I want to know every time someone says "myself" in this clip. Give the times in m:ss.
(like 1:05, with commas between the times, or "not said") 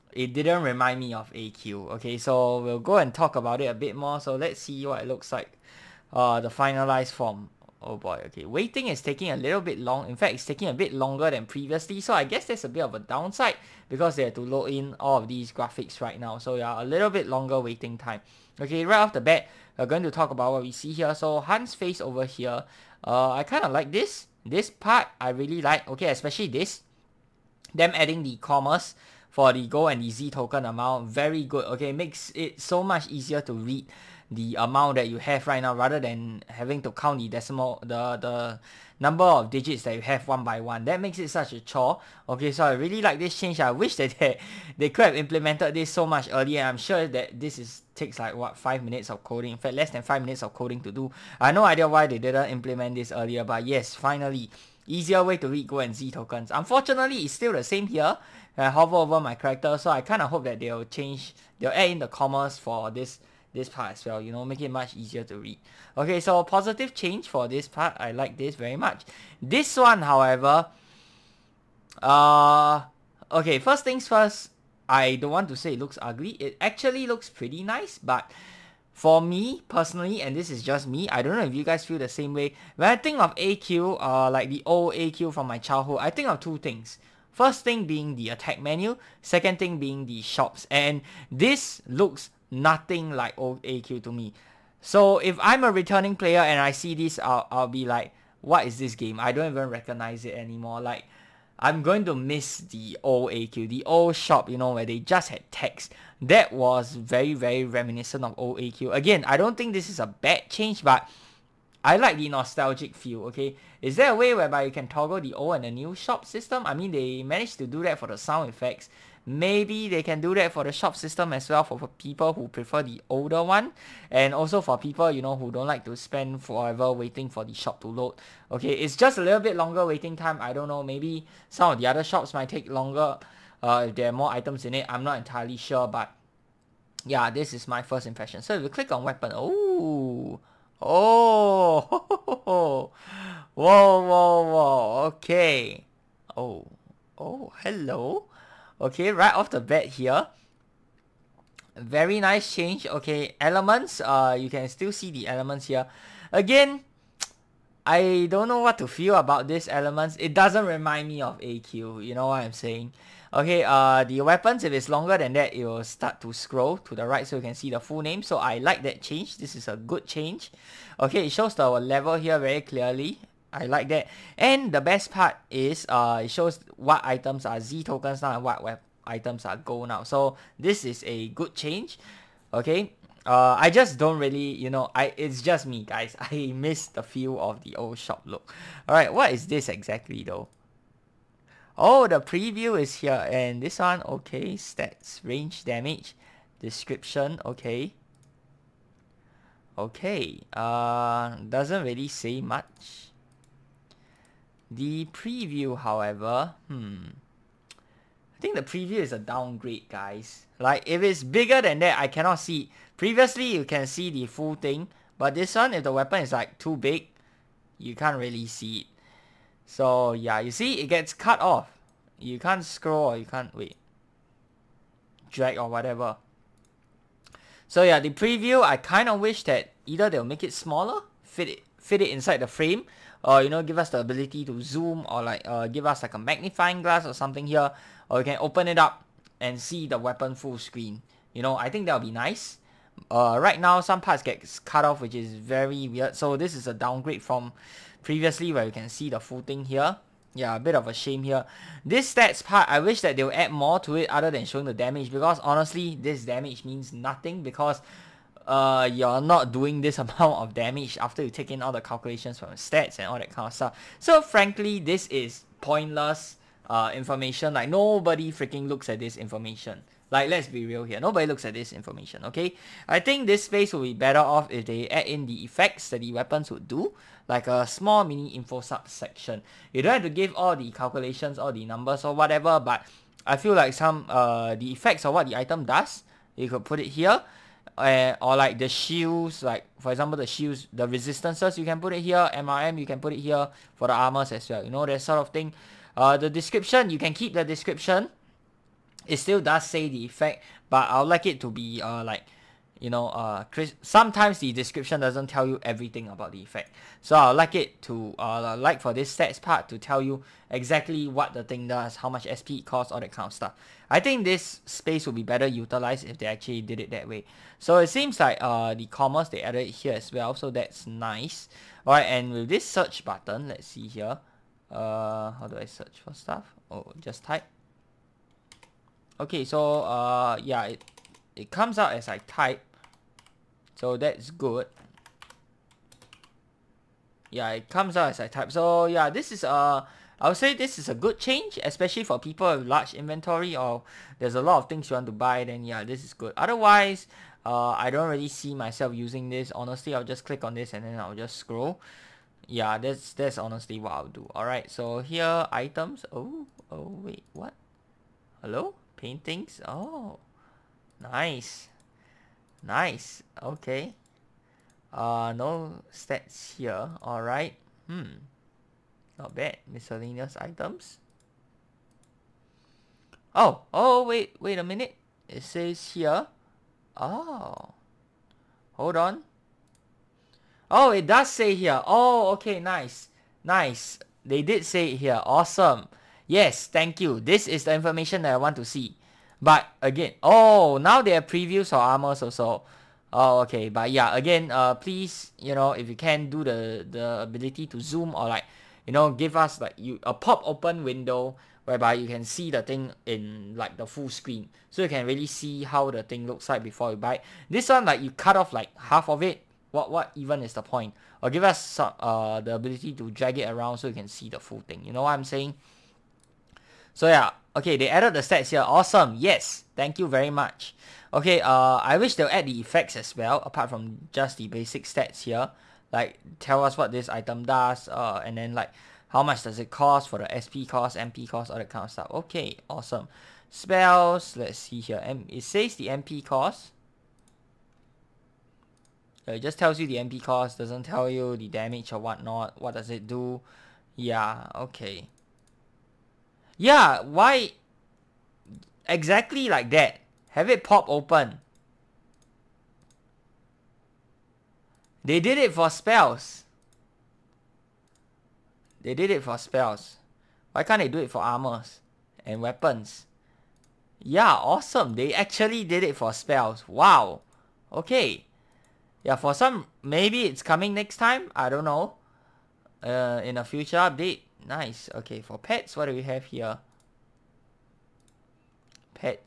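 5:48.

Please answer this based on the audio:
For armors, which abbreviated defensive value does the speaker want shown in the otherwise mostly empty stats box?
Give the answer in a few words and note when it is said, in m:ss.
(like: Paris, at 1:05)
MRM, at 4:52.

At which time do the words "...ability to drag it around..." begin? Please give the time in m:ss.
6:52.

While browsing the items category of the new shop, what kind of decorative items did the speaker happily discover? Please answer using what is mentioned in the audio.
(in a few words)
paintings.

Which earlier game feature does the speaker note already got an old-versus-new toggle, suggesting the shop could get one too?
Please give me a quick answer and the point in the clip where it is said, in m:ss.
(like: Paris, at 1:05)
sound effects, at 1:58.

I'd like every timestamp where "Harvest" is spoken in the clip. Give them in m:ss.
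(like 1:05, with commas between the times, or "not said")
not said.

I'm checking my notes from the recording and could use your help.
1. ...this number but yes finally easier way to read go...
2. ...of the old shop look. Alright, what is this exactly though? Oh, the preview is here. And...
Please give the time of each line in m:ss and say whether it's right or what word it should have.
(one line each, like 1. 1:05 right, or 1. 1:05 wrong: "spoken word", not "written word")
1. 0:52 wrong: "earlier", not "number"
2. 3:07 right.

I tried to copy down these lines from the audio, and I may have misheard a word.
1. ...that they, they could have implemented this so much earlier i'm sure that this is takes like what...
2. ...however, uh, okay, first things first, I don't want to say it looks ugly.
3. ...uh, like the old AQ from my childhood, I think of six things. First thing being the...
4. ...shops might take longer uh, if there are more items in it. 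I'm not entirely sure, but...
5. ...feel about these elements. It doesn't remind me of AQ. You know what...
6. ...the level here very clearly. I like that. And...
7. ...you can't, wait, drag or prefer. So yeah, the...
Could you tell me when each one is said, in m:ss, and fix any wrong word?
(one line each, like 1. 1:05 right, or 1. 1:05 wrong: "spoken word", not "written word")
1. 0:43 right
2. 1:10 right
3. 1:24 wrong: "two", not "six"
4. 2:12 right
5. 2:38 right
6. 2:51 right
7. 3:43 wrong: "whatever", not "prefer".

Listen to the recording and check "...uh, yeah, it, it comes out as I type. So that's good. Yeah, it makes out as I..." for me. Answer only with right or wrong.
wrong.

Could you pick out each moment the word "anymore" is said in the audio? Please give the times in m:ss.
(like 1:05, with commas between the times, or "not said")
1:40.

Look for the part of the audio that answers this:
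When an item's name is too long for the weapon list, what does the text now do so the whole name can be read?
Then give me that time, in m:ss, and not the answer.
2:46.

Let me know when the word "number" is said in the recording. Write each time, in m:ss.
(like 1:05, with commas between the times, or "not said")
0:38, 4:41.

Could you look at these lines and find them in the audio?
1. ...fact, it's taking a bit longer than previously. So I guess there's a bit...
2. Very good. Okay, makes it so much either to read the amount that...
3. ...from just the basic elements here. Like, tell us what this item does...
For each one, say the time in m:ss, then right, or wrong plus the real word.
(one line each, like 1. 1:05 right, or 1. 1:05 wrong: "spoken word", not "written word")
1. 0:10 right
2. 0:31 wrong: "easier", not "either"
3. 7:03 wrong: "stats", not "elements".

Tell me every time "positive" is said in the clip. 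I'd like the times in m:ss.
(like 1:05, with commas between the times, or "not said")
1:06.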